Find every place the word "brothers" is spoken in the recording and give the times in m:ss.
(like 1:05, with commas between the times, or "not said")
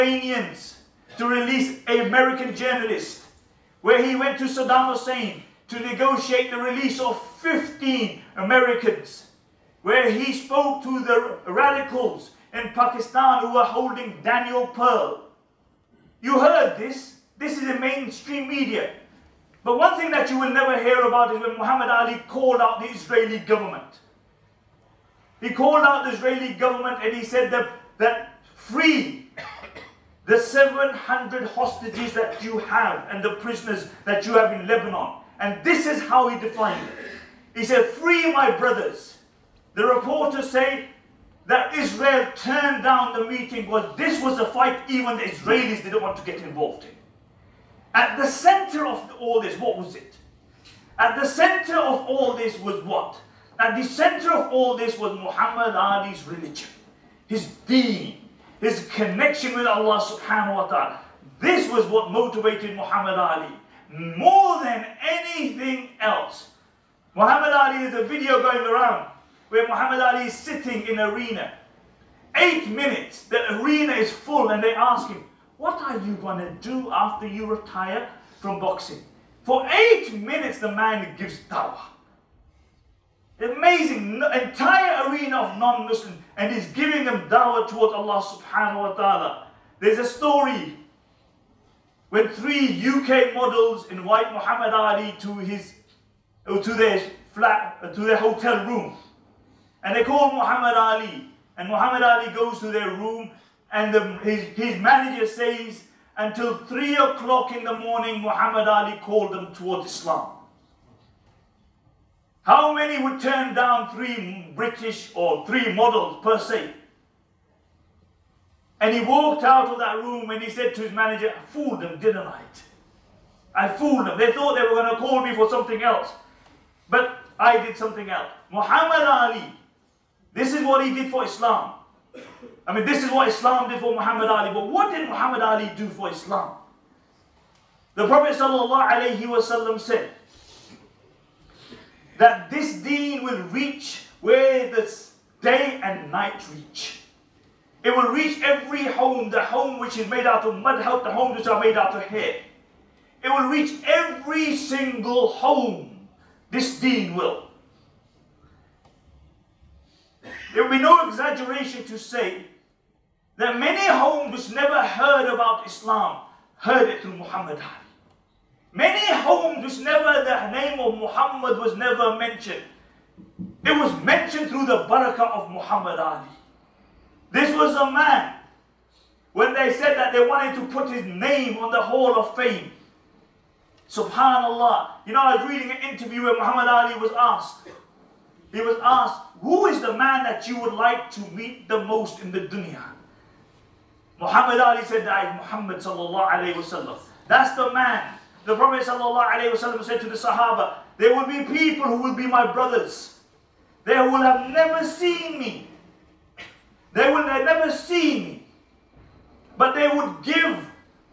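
0:38, 3:22.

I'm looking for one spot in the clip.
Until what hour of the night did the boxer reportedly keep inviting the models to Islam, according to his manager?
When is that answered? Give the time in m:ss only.
1:46.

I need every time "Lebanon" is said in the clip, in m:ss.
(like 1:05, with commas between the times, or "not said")
0:34.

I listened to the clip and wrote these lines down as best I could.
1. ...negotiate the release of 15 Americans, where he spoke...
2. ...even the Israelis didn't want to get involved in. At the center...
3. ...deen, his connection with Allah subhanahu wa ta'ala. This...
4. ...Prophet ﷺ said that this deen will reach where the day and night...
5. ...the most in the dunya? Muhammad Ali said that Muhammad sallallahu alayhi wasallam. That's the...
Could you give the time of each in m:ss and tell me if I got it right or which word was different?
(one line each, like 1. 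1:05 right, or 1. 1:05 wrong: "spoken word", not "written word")
1. 0:05 right
2. 0:44 right
3. 0:57 right
4. 2:18 right
5. 3:11 right.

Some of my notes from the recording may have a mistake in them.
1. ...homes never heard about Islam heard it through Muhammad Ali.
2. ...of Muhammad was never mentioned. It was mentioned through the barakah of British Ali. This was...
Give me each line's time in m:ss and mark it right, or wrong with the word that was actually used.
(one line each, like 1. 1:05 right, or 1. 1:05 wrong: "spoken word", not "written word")
1. 2:43 right
2. 2:50 wrong: "Muhammad", not "British".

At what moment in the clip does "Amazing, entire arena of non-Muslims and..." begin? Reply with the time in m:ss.
1:23.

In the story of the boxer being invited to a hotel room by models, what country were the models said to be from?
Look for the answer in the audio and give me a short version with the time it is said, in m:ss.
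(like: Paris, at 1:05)
UK, at 1:32.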